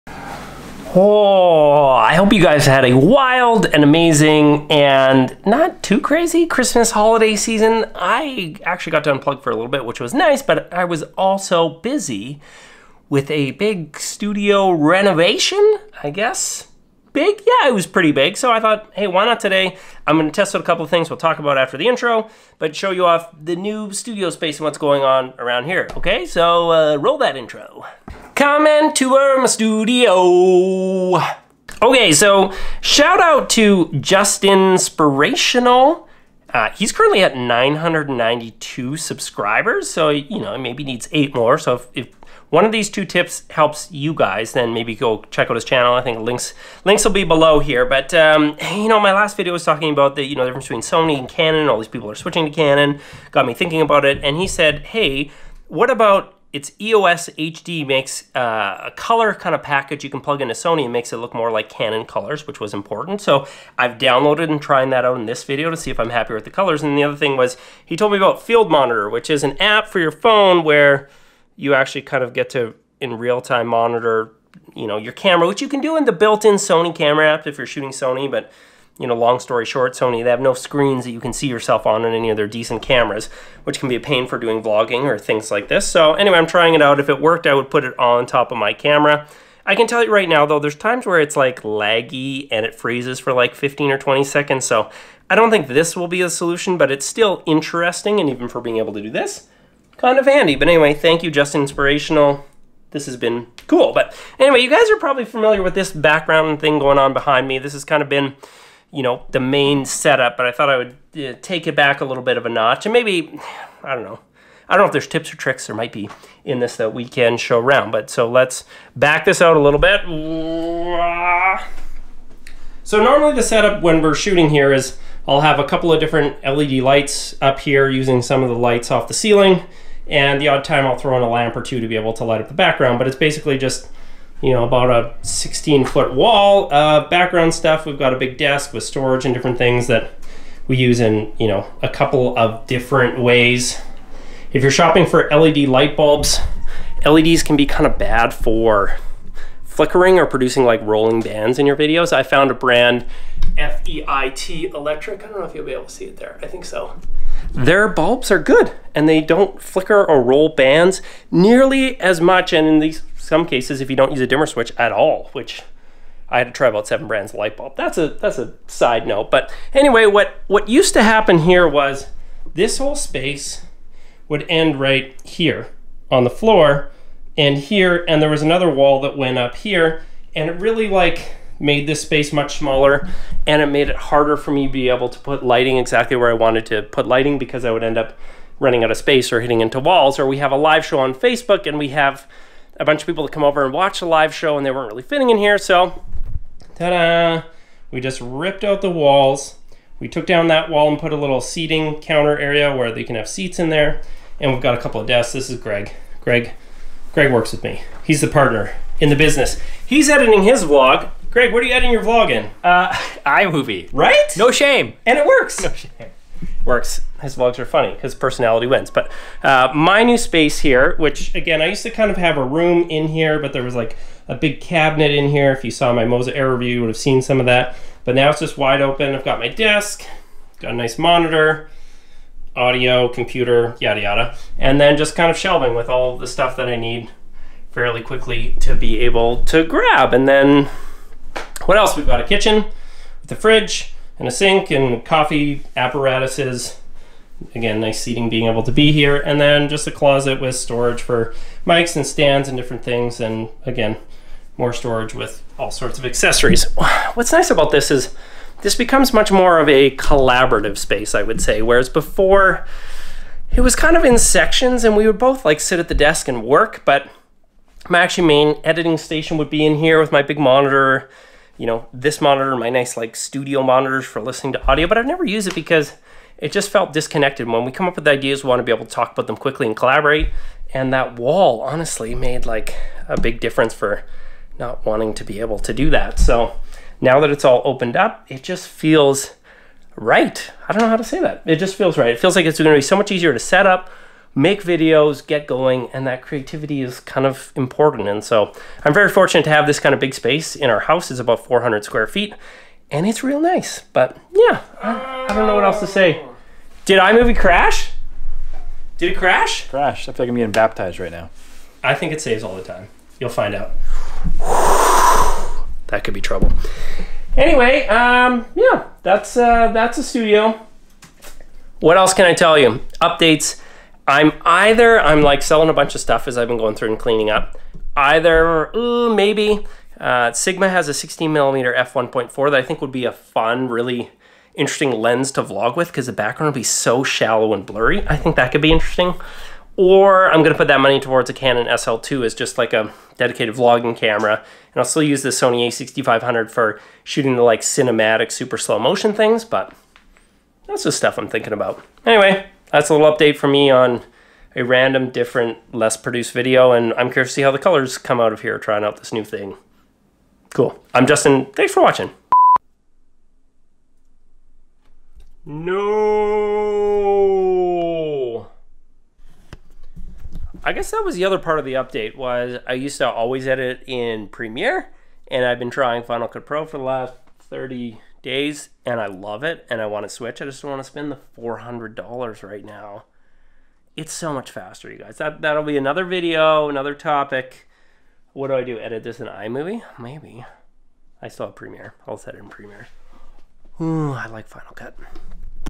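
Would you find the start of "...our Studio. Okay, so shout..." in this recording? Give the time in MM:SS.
00:29.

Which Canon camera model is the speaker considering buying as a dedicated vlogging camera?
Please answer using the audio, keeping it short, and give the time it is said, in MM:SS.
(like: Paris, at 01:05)
Canon SL2, at 05:41.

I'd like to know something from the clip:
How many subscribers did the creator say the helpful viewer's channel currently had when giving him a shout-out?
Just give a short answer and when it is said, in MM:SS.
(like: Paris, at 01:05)
992, at 00:37.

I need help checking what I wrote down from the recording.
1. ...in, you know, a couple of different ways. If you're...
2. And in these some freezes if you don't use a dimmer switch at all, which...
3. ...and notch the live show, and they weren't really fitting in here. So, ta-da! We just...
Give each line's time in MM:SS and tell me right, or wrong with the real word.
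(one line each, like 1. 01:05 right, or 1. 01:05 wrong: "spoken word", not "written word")
1. 02:20 right
2. 02:42 wrong: "cases", not "freezes"
3. 03:13 wrong: "watch", not "notch".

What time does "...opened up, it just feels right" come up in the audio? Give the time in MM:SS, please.
04:47.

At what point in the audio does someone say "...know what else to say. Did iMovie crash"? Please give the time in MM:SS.
05:05.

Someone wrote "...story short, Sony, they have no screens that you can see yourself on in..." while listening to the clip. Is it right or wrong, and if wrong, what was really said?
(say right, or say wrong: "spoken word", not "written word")
right.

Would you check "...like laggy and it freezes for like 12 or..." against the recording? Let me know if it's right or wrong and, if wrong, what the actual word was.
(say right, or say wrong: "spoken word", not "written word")
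wrong: "15", not "12".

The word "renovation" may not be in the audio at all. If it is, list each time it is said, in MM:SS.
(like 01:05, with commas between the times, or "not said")
00:14.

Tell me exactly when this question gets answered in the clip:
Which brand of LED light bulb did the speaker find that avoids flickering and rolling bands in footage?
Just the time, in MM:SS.
02:33.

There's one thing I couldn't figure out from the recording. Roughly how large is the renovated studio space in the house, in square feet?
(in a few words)
400 square feet.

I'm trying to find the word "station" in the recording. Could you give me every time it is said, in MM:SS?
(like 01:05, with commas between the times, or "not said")
04:28.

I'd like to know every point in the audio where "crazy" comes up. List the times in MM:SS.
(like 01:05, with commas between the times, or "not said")
00:06.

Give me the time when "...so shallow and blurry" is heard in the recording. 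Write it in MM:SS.
05:36.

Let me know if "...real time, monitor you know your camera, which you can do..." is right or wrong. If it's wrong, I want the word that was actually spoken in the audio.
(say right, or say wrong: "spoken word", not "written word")
right.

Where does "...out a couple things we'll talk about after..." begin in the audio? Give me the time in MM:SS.
00:20.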